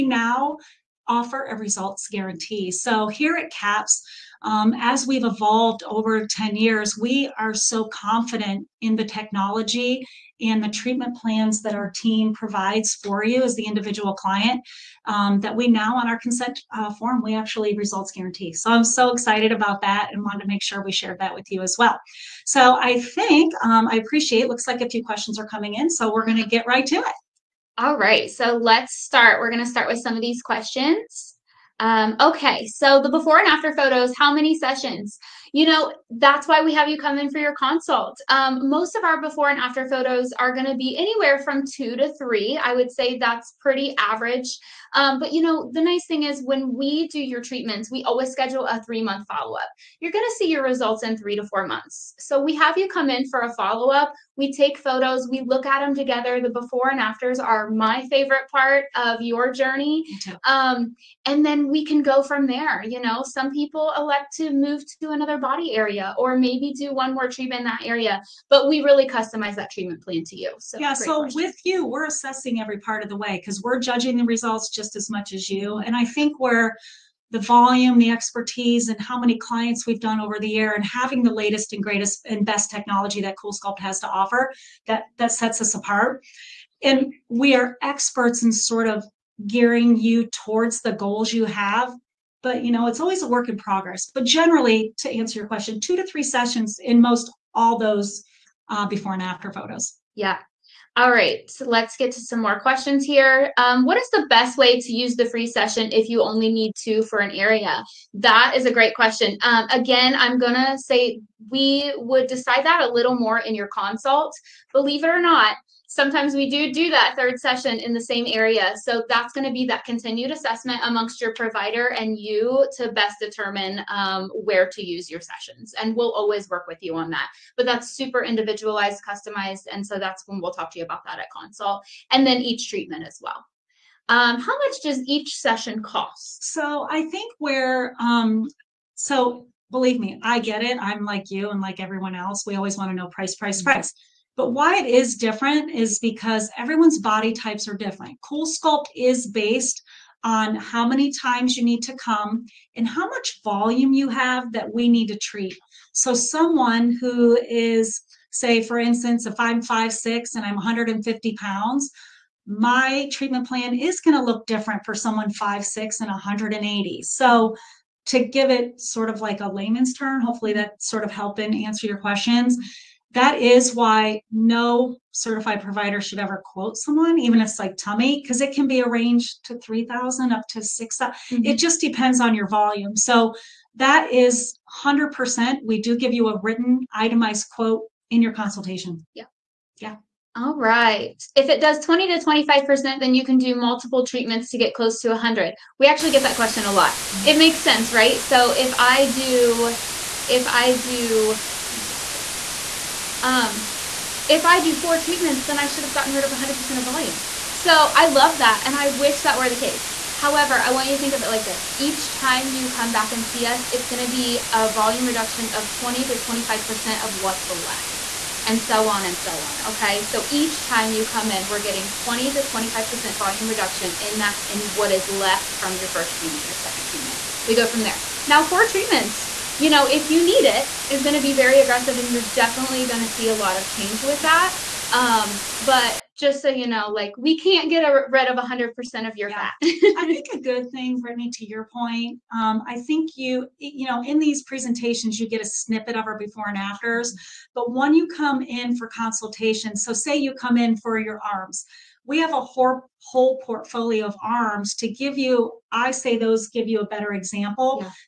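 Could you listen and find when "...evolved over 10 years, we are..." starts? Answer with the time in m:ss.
0:05.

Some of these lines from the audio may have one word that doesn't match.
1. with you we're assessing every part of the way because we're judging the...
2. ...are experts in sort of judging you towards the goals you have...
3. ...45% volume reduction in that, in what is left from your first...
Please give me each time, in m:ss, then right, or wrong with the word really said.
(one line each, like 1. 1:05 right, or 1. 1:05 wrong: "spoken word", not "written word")
1. 1:11 right
2. 1:27 wrong: "gearing", not "judging"
3. 3:42 wrong: "25", not "45".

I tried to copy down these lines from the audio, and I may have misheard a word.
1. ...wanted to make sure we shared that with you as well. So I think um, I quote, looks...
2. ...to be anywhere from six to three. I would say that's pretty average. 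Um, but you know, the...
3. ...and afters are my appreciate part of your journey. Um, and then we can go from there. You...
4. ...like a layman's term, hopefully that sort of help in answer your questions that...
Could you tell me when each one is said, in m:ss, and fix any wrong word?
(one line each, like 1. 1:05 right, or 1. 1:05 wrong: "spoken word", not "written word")
1. 0:20 wrong: "appreciate", not "quote"
2. 0:40 wrong: "two", not "six"
3. 0:56 wrong: "favorite", not "appreciate"
4. 2:49 right.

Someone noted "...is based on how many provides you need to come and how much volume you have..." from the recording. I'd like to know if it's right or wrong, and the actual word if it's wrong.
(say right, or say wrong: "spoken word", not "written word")
wrong: "times", not "provides".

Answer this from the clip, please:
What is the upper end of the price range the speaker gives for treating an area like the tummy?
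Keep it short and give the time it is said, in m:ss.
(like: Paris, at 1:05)
$6,000, at 3:00.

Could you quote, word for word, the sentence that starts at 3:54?
Um, but just so you know, like we can't get a, rid of 100% of your yeah.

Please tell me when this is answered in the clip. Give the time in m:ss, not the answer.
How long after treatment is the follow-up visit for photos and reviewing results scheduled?
0:48.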